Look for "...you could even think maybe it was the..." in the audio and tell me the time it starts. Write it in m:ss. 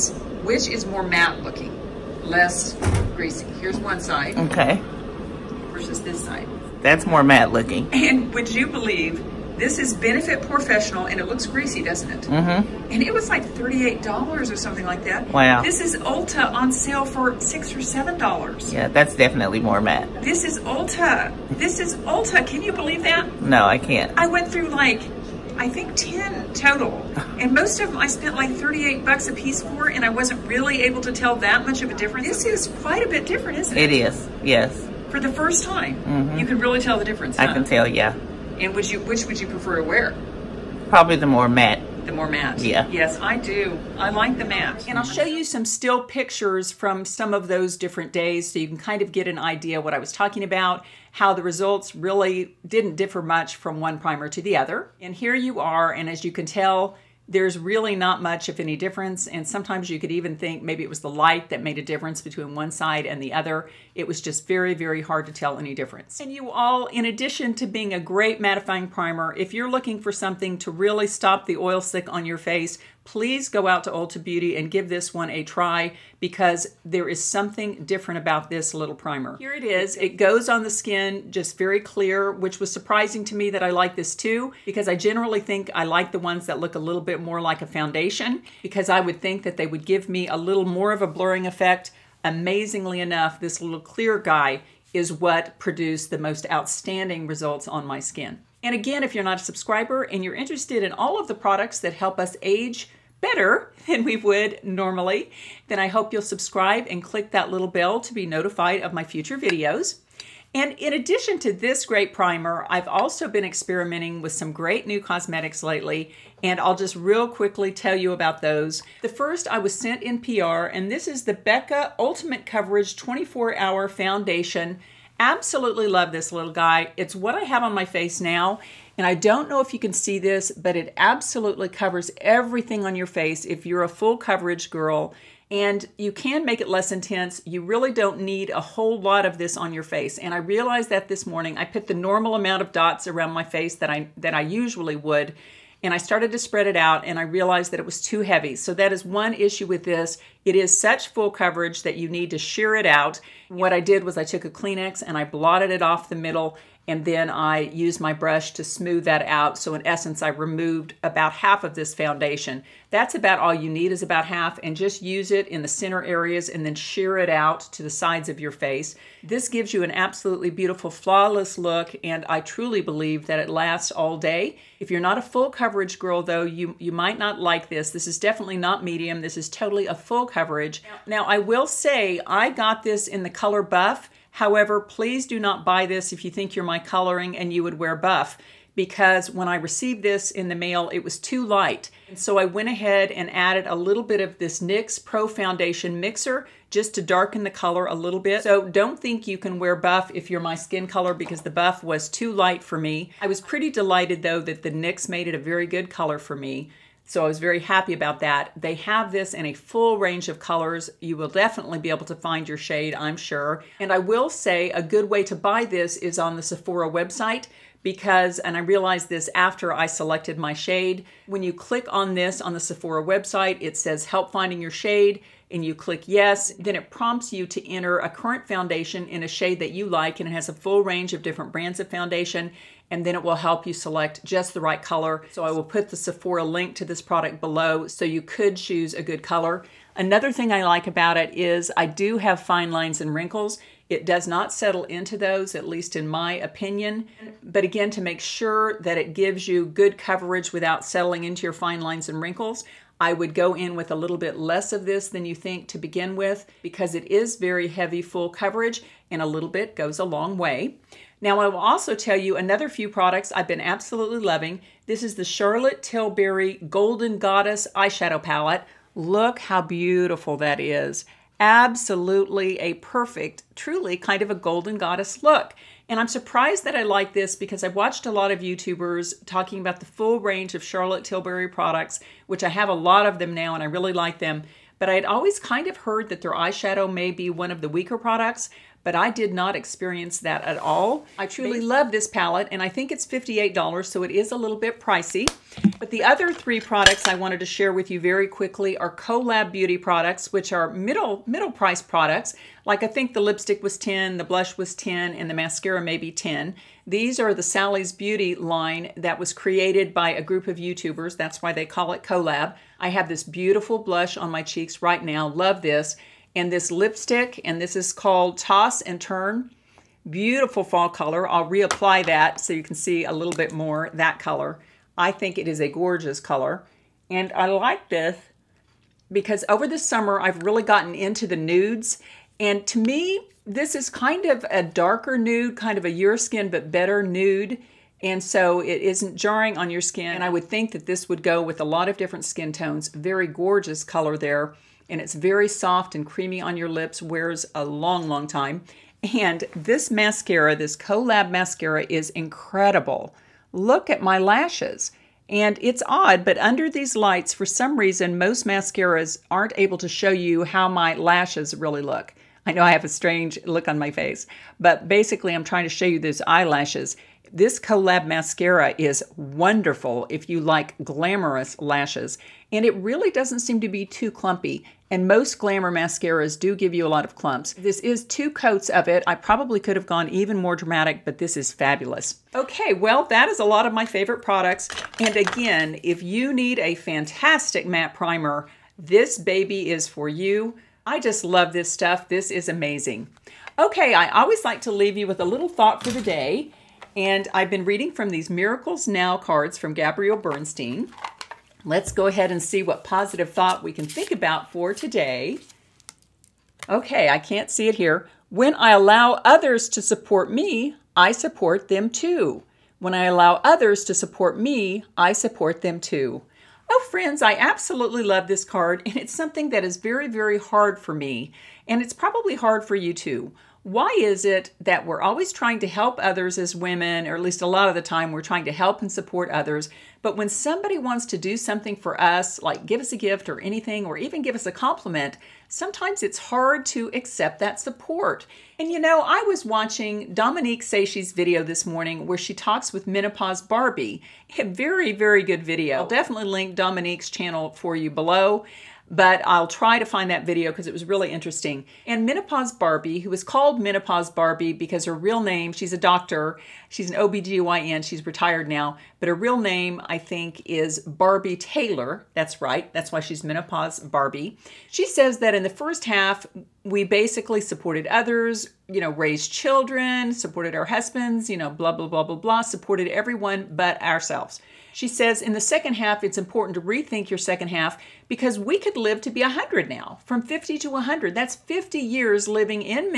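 0:59.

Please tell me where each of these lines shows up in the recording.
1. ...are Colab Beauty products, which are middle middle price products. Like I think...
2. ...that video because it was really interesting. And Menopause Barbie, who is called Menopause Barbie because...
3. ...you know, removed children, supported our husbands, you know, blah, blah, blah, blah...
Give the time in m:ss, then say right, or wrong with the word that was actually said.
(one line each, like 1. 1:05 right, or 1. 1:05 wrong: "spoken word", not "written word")
1. 4:58 right
2. 7:30 right
3. 7:48 wrong: "raised", not "removed".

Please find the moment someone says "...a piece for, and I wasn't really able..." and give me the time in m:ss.
0:29.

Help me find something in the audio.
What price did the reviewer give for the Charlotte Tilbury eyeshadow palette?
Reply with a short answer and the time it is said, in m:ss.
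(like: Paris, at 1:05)
$58, at 4:53.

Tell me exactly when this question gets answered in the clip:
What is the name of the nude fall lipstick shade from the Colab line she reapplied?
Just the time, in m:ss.
5:18.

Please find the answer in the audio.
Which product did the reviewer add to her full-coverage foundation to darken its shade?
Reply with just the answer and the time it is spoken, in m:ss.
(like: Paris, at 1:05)
NYX Pro Foundation Mixer, at 3:14.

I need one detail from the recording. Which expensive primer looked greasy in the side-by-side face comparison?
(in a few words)
Benefit POREfessional.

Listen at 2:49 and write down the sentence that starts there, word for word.
This gives you an absolutely beautiful flawless look and I truly believe that it lasts all day.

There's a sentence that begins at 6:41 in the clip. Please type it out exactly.
Let's go ahead and see what positive thought we can think about for today.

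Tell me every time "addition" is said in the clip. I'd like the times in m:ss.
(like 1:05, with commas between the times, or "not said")
1:07, 1:50.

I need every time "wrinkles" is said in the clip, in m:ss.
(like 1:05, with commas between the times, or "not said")
4:03, 4:12.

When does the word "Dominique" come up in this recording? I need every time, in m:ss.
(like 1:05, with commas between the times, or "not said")
7:20, 7:26.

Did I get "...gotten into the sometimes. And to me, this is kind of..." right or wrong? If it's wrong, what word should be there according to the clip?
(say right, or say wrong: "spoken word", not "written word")
wrong: "nudes", not "sometimes".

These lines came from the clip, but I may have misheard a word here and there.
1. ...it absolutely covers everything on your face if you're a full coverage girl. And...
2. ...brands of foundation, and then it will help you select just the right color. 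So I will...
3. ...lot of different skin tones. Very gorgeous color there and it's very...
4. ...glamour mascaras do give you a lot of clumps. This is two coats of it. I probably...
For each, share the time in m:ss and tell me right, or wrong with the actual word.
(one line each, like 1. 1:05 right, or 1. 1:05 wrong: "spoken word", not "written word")
1. 2:10 right
2. 3:51 right
3. 5:41 right
4. 6:15 right.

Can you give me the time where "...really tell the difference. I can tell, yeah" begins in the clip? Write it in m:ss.
0:36.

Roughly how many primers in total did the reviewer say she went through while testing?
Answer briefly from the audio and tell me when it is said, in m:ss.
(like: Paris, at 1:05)
10, at 0:25.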